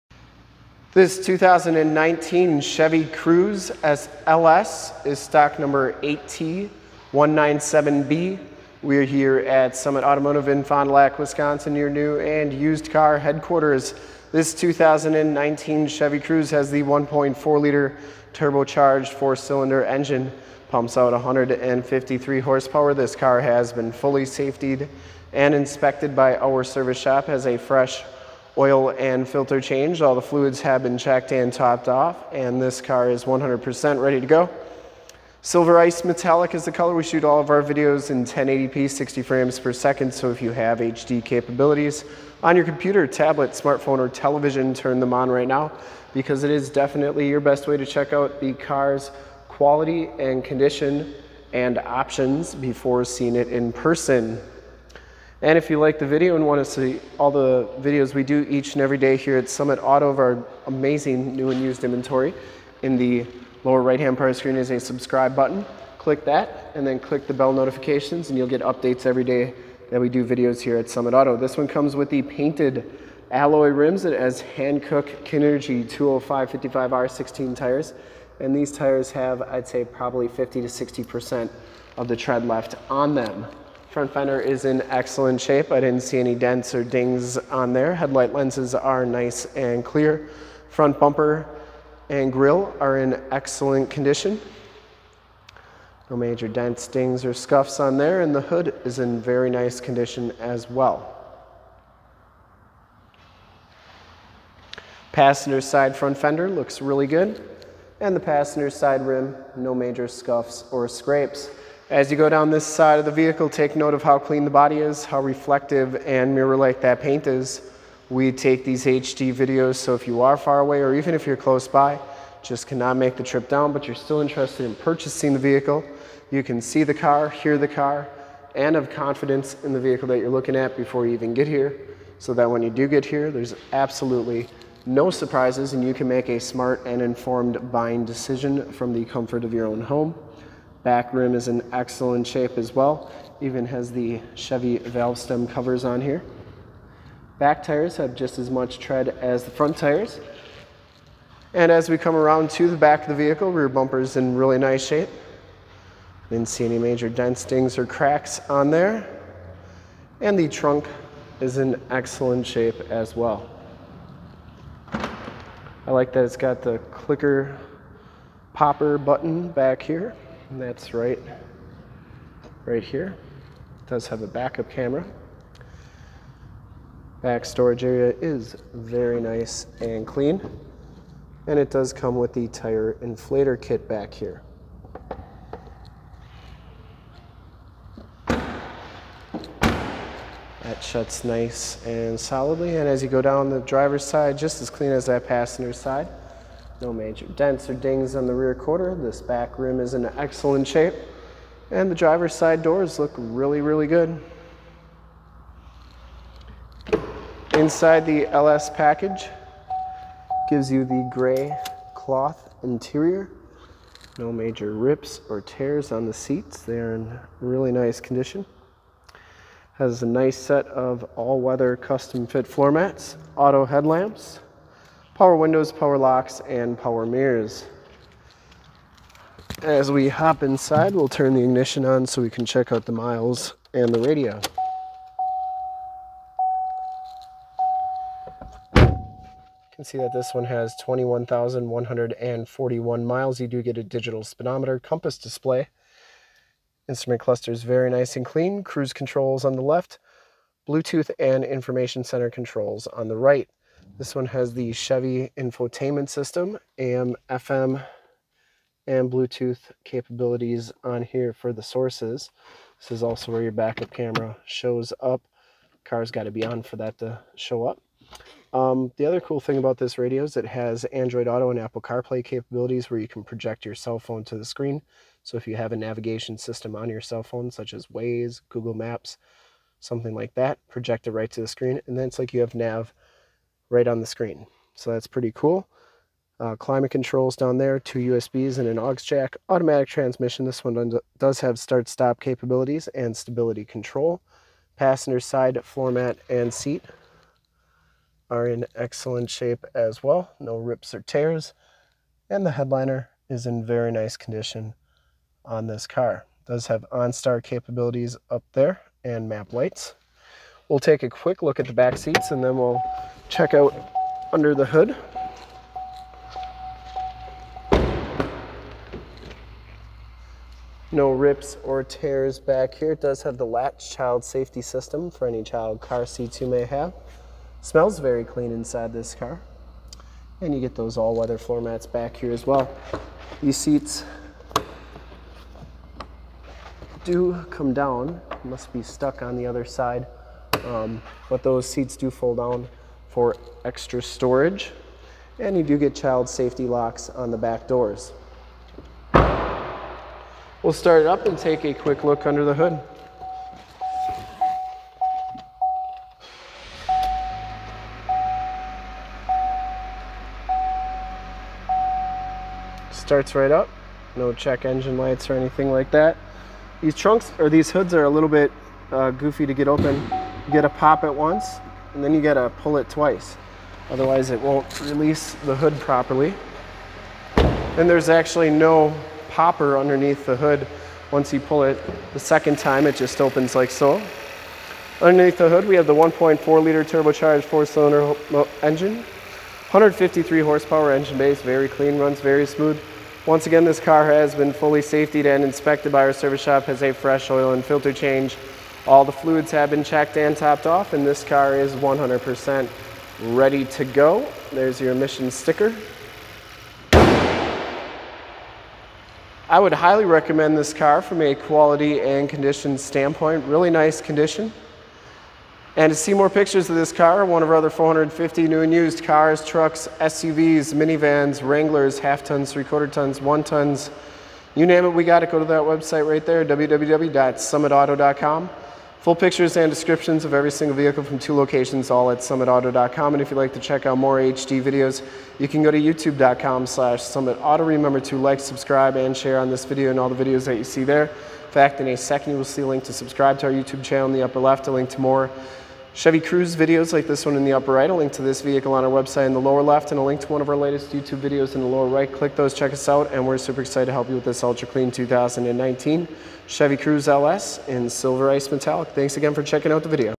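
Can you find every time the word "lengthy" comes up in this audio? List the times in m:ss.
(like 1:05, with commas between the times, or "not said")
not said.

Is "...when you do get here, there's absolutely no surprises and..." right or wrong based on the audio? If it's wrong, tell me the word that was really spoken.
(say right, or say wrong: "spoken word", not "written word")
right.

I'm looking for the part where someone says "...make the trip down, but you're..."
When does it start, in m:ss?
2:02.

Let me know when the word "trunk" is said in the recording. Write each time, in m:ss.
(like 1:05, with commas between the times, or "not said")
2:40, 6:06.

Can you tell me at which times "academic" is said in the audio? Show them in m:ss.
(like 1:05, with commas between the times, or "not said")
not said.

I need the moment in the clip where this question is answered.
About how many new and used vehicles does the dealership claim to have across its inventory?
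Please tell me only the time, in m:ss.
6:57.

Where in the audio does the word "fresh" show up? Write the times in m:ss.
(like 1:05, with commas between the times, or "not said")
0:27, 6:36.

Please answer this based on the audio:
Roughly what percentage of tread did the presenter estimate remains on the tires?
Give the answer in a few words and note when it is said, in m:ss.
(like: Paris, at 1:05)
50 to 60%, at 1:20.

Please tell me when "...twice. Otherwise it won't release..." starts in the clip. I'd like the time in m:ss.
6:12.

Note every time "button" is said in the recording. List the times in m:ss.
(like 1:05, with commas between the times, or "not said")
1:05, 2:48.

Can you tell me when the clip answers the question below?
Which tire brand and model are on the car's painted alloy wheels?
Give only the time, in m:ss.
1:14.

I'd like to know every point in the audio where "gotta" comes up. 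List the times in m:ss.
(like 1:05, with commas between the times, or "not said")
6:12.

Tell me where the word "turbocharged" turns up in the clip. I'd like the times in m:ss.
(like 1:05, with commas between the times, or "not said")
0:18, 6:26.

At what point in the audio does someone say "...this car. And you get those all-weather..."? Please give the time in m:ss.
5:28.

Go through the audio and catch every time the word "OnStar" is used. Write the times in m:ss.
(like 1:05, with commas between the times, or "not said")
5:06.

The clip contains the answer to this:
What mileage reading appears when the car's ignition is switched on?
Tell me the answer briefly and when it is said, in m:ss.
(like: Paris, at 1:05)
21,141 miles, at 4:00.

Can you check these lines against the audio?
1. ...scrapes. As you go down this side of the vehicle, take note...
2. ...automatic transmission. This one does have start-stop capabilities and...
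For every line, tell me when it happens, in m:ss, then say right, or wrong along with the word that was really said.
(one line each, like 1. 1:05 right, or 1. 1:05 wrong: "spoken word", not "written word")
1. 1:50 right
2. 4:49 right.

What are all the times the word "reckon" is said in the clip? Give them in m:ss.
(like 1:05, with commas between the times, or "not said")
not said.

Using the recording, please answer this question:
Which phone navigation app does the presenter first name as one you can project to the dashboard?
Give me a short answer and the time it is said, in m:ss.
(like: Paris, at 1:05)
Waze, at 4:37.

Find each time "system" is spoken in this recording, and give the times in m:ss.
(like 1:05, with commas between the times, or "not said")
4:16, 4:36, 5:24.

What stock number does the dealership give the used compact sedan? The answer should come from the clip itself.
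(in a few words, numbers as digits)
8T197B.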